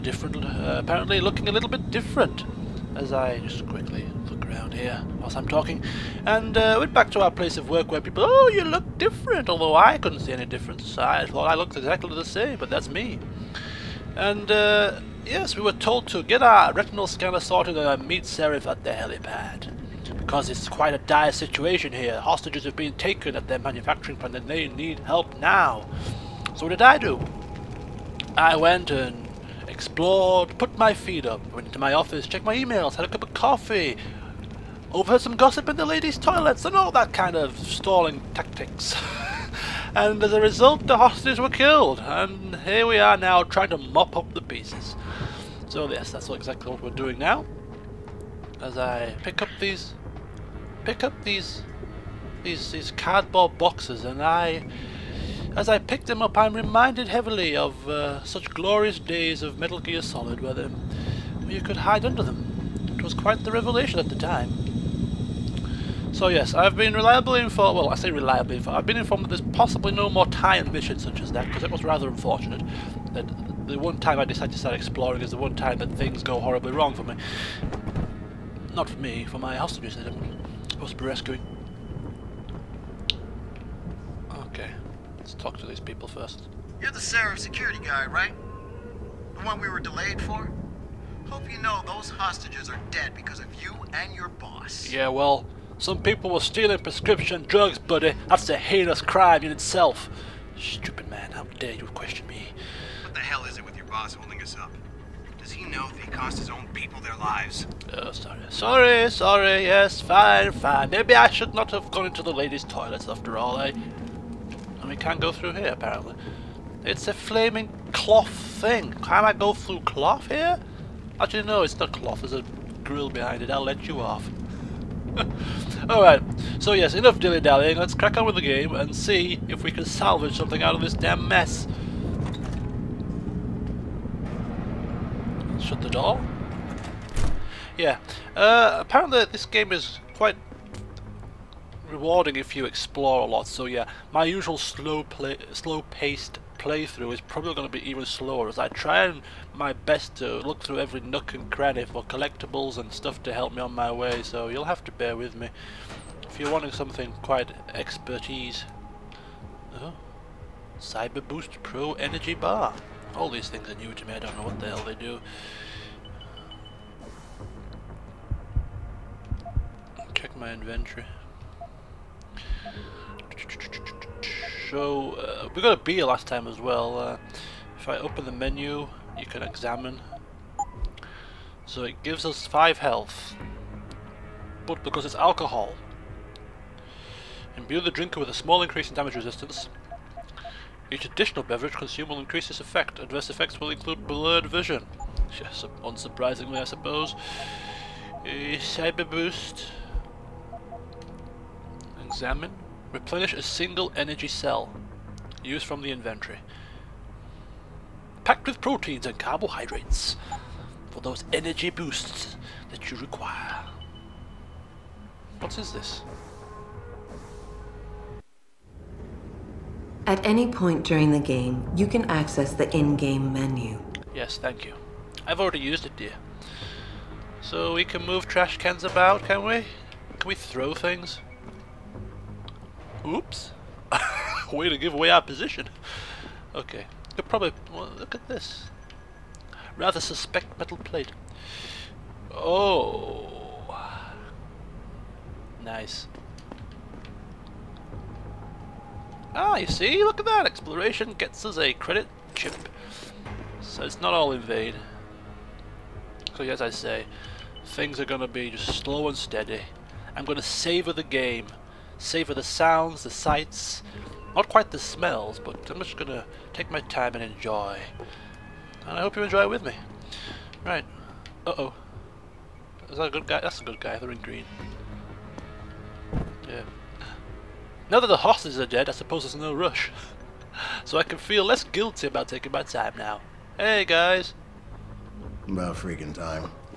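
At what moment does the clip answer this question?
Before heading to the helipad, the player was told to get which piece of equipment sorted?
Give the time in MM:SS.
00:16.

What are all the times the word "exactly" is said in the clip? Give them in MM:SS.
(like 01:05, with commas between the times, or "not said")
00:11, 00:46.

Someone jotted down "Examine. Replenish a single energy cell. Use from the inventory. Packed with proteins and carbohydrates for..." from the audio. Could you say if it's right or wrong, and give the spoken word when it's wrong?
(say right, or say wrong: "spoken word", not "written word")
right.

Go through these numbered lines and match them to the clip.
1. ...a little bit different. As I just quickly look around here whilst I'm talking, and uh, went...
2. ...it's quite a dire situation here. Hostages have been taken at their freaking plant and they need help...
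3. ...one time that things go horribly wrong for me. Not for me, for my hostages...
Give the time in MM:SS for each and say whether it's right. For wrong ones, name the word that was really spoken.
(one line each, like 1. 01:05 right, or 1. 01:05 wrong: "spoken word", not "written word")
1. 00:01 right
2. 00:20 wrong: "manufacturing", not "freaking"
3. 01:15 right.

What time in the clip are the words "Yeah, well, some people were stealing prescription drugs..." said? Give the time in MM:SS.
01:34.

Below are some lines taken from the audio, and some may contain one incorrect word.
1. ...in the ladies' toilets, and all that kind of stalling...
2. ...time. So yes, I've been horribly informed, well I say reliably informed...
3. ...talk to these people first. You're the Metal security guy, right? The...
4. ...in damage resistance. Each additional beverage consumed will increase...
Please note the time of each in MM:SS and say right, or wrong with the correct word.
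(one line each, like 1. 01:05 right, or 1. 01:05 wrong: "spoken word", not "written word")
1. 00:35 right
2. 01:04 wrong: "reliably", not "horribly"
3. 01:25 wrong: "Sarif", not "Metal"
4. 03:08 right.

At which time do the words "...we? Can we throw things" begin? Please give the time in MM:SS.
03:49.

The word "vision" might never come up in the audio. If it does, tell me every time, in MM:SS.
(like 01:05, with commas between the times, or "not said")
03:14.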